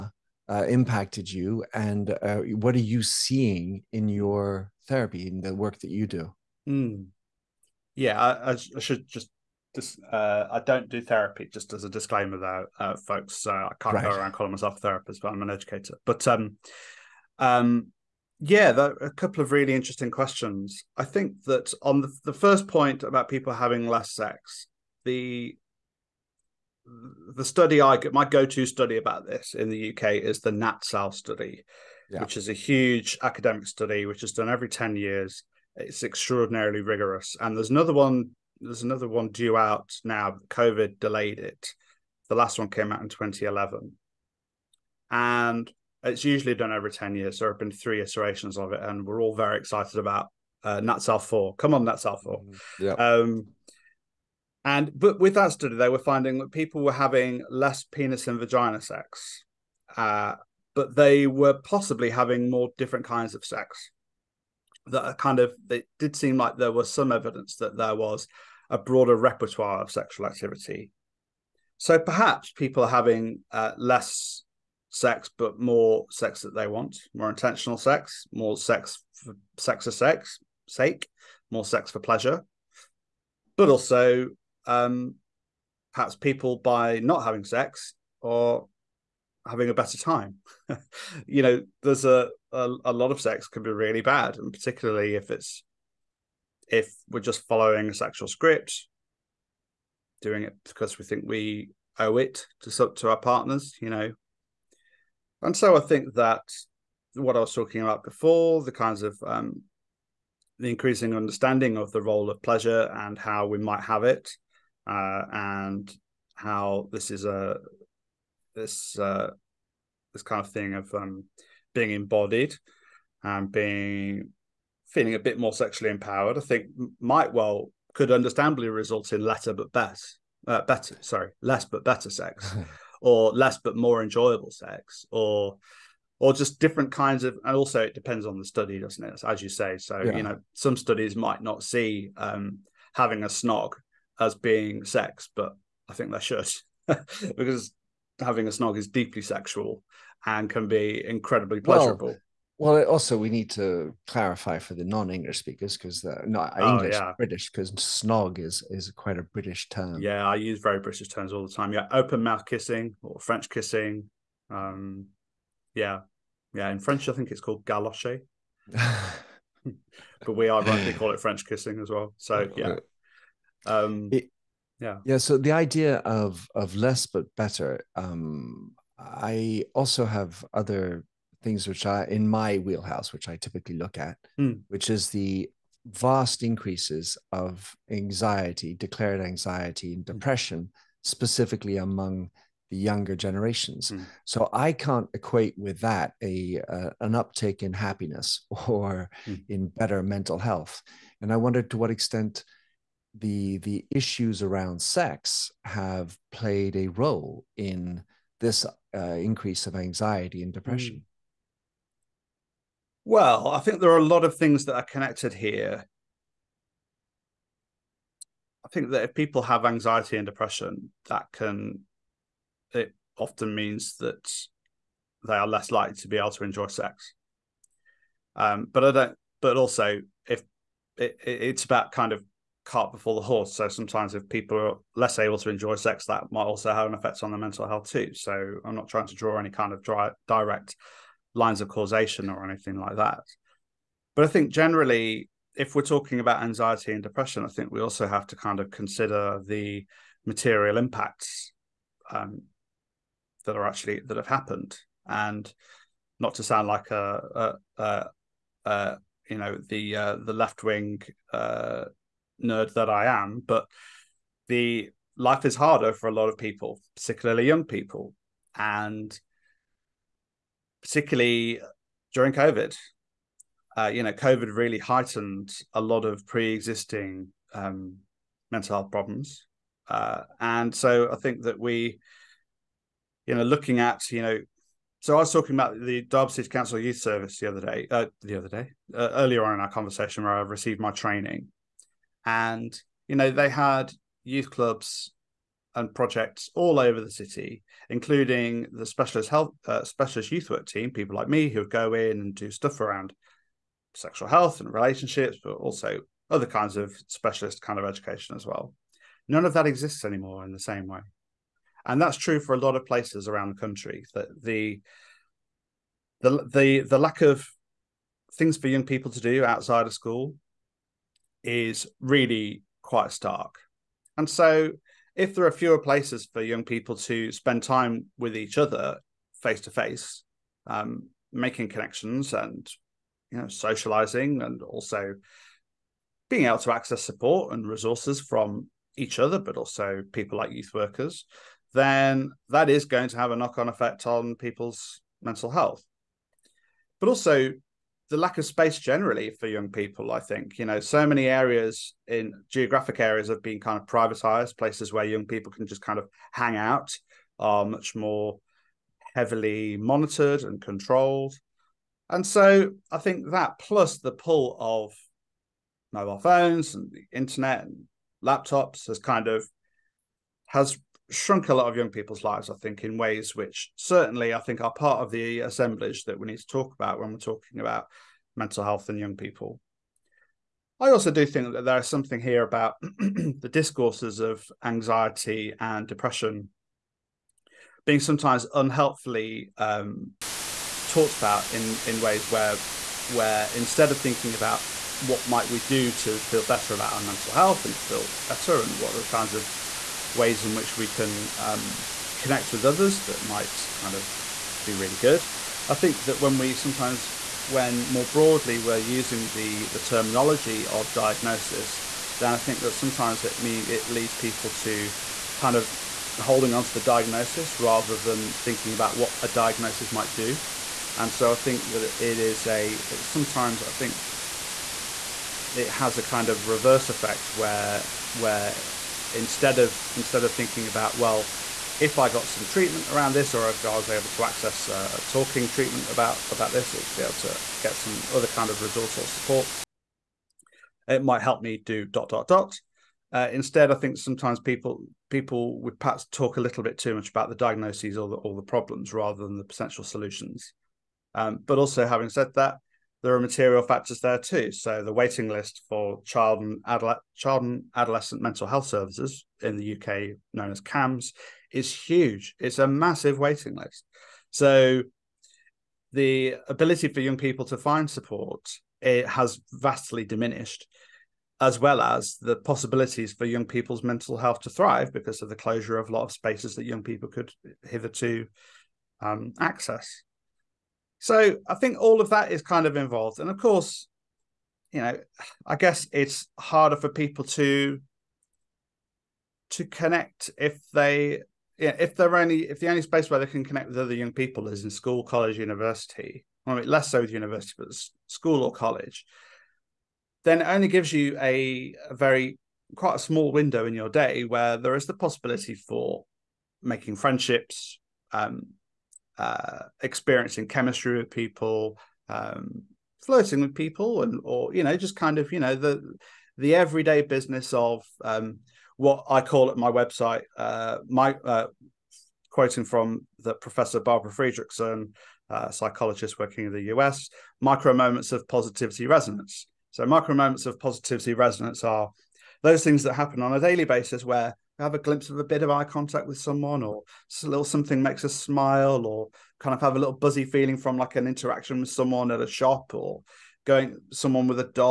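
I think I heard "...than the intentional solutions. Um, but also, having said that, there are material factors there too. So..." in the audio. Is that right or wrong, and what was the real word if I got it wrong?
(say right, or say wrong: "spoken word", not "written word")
wrong: "potential", not "intentional".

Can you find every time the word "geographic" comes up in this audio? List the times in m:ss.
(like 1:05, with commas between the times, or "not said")
5:52.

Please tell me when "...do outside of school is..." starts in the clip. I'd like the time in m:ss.
5:19.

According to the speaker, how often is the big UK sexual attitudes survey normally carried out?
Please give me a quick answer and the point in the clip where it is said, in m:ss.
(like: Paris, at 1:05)
Every 10 years, at 0:34.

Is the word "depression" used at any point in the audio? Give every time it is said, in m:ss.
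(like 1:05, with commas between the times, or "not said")
3:10, 3:30, 3:40, 4:07, 6:25.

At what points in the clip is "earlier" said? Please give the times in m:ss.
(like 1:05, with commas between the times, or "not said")
4:49.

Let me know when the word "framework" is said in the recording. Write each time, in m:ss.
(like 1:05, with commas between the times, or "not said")
not said.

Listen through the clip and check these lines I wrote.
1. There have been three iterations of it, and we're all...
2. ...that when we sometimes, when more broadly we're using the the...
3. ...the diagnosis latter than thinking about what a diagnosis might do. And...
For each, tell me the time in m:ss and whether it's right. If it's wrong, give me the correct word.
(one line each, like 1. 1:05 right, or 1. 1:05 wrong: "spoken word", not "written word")
1. 0:47 right
2. 6:46 right
3. 6:56 wrong: "rather", not "latter".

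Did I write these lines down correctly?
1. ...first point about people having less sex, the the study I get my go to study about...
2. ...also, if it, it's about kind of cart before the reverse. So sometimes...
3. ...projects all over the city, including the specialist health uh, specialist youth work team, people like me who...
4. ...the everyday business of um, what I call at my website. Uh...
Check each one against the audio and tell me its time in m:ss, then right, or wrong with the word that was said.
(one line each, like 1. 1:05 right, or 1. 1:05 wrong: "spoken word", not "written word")
1. 0:22 right
2. 3:49 wrong: "horse", not "reverse"
3. 4:55 right
4. 8:36 right.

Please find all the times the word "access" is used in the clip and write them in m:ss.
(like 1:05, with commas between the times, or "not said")
5:36, 7:14, 7:59.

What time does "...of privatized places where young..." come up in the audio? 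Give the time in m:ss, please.
5:53.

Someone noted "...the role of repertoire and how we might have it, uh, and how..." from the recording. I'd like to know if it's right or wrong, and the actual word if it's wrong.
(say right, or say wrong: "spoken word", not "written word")
wrong: "pleasure", not "repertoire".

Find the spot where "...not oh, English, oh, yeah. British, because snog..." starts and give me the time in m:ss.
2:36.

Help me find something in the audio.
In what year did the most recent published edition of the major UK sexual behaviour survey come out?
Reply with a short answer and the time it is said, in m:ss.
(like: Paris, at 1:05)
2011, at 0:43.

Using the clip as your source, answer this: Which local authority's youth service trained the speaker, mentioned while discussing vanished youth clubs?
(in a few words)
Derby City Council.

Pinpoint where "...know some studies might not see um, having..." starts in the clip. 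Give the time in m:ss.
2:20.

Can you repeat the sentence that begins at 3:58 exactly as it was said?
So I'm not trying to draw any kind of dry, direct lines of causation or anything like that.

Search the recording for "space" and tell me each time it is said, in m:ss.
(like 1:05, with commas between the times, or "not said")
5:48, 7:56, 8:12.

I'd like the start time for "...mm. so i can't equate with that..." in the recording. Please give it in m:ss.
3:13.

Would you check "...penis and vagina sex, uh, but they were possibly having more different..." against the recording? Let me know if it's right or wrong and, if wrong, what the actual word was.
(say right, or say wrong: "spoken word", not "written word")
right.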